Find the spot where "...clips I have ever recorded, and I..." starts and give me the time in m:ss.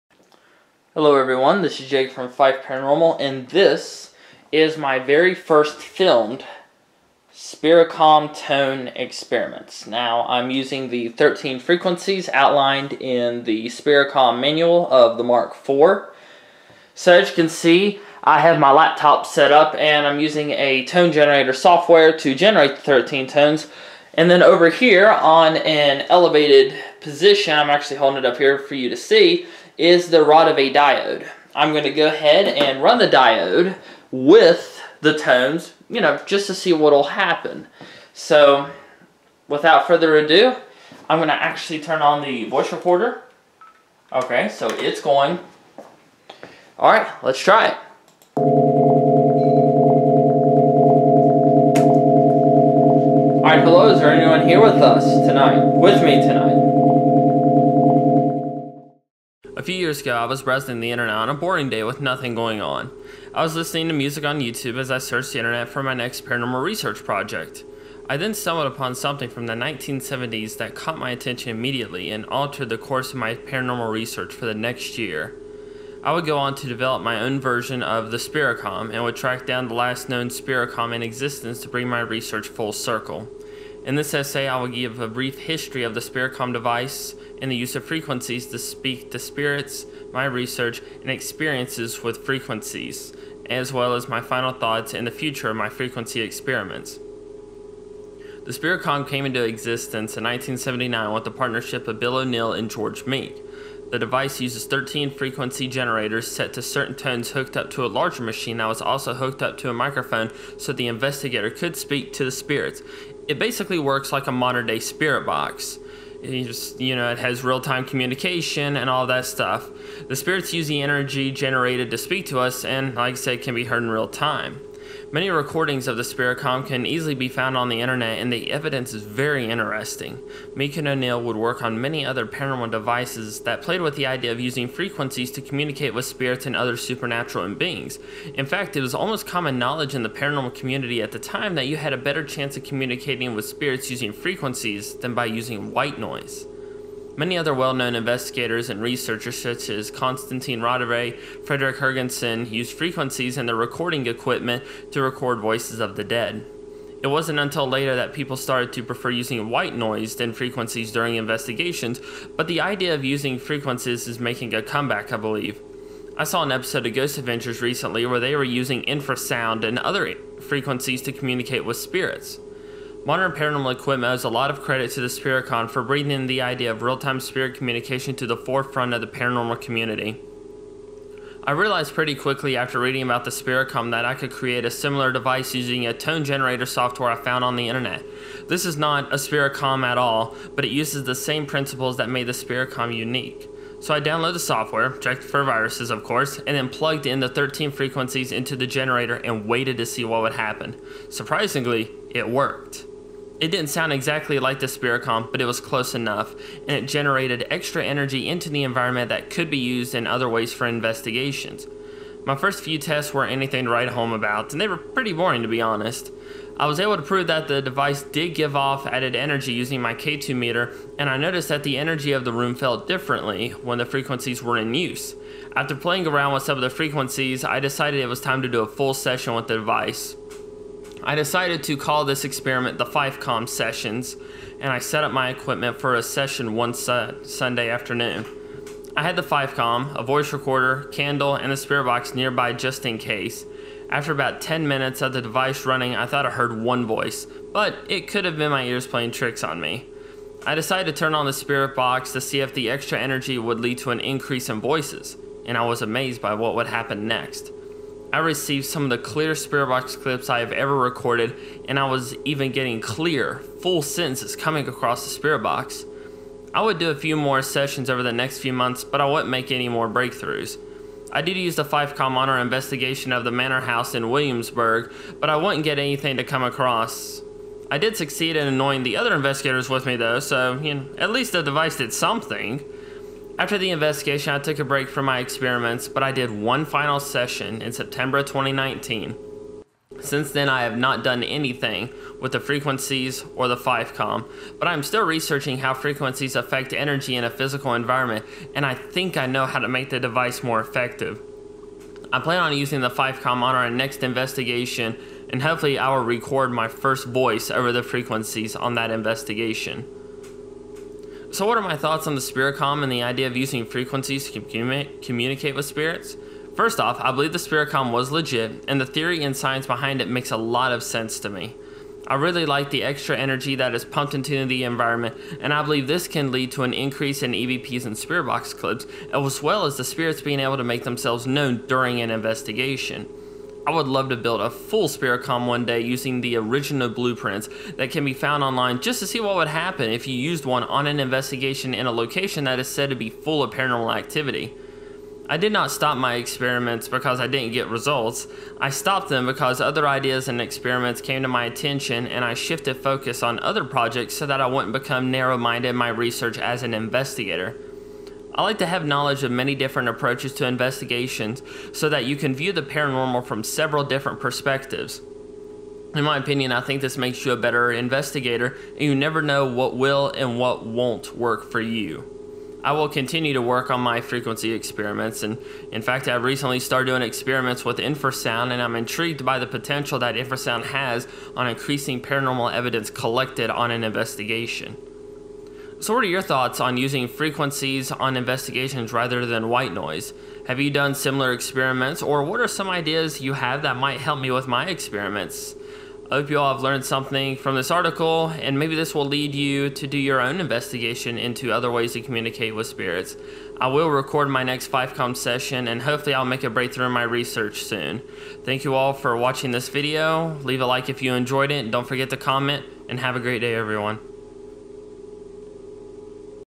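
4:19.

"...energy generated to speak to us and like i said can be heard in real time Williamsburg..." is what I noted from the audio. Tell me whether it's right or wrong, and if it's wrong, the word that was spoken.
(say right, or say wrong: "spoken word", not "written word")
wrong: "Many", not "Williamsburg".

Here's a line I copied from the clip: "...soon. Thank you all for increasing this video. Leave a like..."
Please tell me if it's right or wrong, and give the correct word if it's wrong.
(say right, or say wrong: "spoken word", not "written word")
wrong: "watching", not "increasing".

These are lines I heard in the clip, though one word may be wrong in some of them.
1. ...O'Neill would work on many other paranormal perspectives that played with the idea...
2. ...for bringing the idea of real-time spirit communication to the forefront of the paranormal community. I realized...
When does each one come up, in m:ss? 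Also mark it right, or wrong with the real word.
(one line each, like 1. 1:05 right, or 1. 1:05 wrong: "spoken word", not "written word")
1. 2:10 wrong: "devices", not "perspectives"
2. 2:55 right.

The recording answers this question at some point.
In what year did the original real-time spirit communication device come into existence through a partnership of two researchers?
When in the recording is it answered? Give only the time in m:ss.
1:40.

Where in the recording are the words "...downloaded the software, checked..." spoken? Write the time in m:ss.
3:13.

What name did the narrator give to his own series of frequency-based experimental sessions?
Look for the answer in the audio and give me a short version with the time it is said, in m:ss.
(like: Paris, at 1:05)
Fifecom sessions, at 3:52.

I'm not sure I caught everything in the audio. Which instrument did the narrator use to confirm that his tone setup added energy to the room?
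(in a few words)
K2 meter.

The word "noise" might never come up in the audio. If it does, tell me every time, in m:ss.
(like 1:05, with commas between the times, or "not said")
2:25, 2:39, 6:29.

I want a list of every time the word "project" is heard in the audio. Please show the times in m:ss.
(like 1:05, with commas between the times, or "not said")
1:07, 5:53.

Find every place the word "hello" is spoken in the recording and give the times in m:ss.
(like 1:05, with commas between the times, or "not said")
0:00, 0:53.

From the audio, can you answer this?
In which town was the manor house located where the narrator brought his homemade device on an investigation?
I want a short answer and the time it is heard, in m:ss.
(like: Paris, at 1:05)
Williamsburg, at 4:34.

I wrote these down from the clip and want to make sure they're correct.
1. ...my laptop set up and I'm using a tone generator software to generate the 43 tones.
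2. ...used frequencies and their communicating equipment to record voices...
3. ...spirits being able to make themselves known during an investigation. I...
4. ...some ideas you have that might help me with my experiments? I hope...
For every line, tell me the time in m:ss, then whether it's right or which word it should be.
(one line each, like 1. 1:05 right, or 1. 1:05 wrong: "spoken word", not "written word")
1. 0:18 wrong: "13", not "43"
2. 2:32 wrong: "recording", not "communicating"
3. 5:29 right
4. 6:32 right.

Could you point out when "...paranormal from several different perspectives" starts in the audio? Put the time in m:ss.
6:02.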